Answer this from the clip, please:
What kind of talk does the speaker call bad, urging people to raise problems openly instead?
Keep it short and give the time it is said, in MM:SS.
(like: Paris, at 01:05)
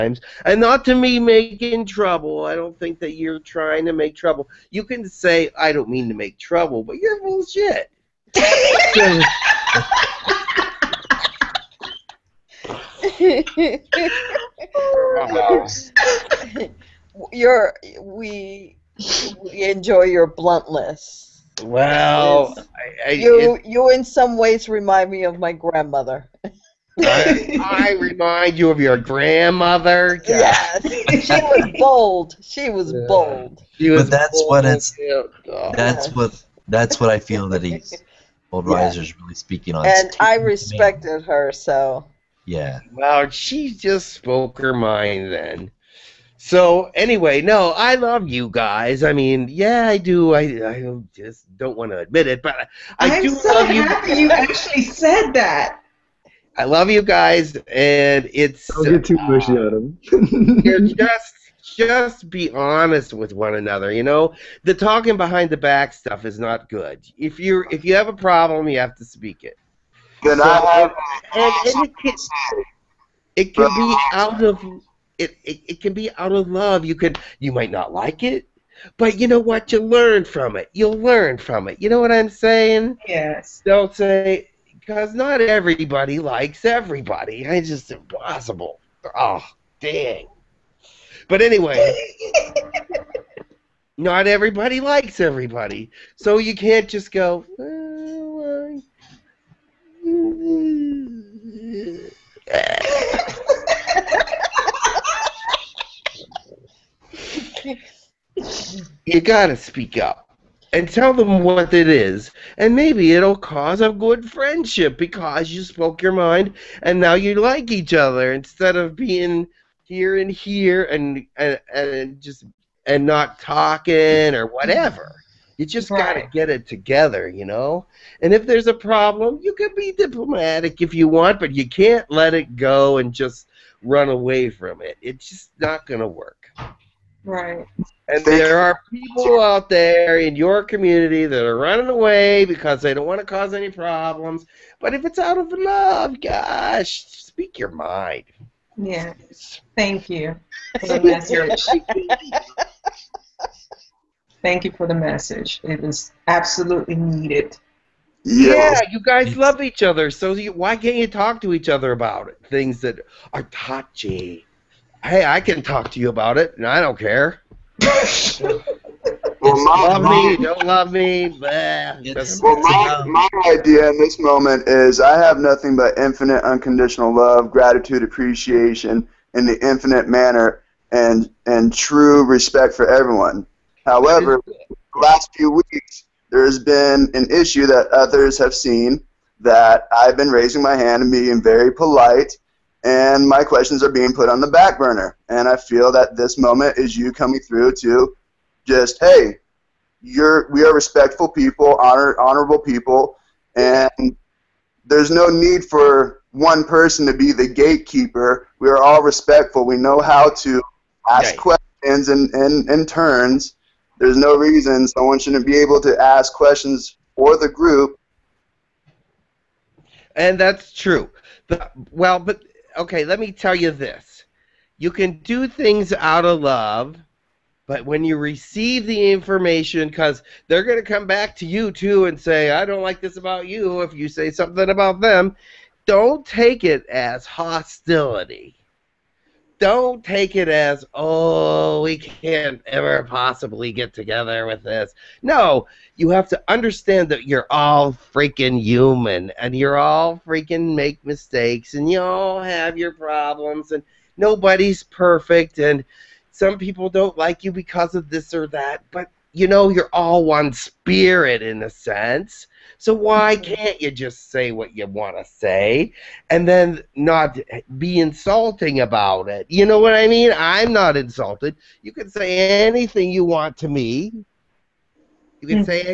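talking behind the back, at 01:04.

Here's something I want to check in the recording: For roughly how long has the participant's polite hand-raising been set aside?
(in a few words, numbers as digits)
last few weeks.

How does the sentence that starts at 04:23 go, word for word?
can't you just say what you want to say and then not be insulting about it?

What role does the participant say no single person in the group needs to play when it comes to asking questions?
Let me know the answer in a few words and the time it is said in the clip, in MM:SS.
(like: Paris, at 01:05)
gatekeeper, at 03:27.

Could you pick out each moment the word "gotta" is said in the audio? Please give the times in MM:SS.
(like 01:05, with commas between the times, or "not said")
01:49, 02:05.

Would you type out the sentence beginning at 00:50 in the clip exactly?
I, I just don't want to admit it, but I I'm do so love you.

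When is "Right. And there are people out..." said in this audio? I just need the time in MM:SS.
02:17.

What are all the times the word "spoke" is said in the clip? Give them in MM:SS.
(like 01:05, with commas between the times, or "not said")
00:44, 01:55.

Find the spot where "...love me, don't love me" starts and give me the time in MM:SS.
02:49.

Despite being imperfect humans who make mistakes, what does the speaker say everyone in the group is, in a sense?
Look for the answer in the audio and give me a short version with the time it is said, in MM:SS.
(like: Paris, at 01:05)
one spirit, at 04:20.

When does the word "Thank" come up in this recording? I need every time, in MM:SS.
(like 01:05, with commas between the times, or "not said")
02:29, 02:34.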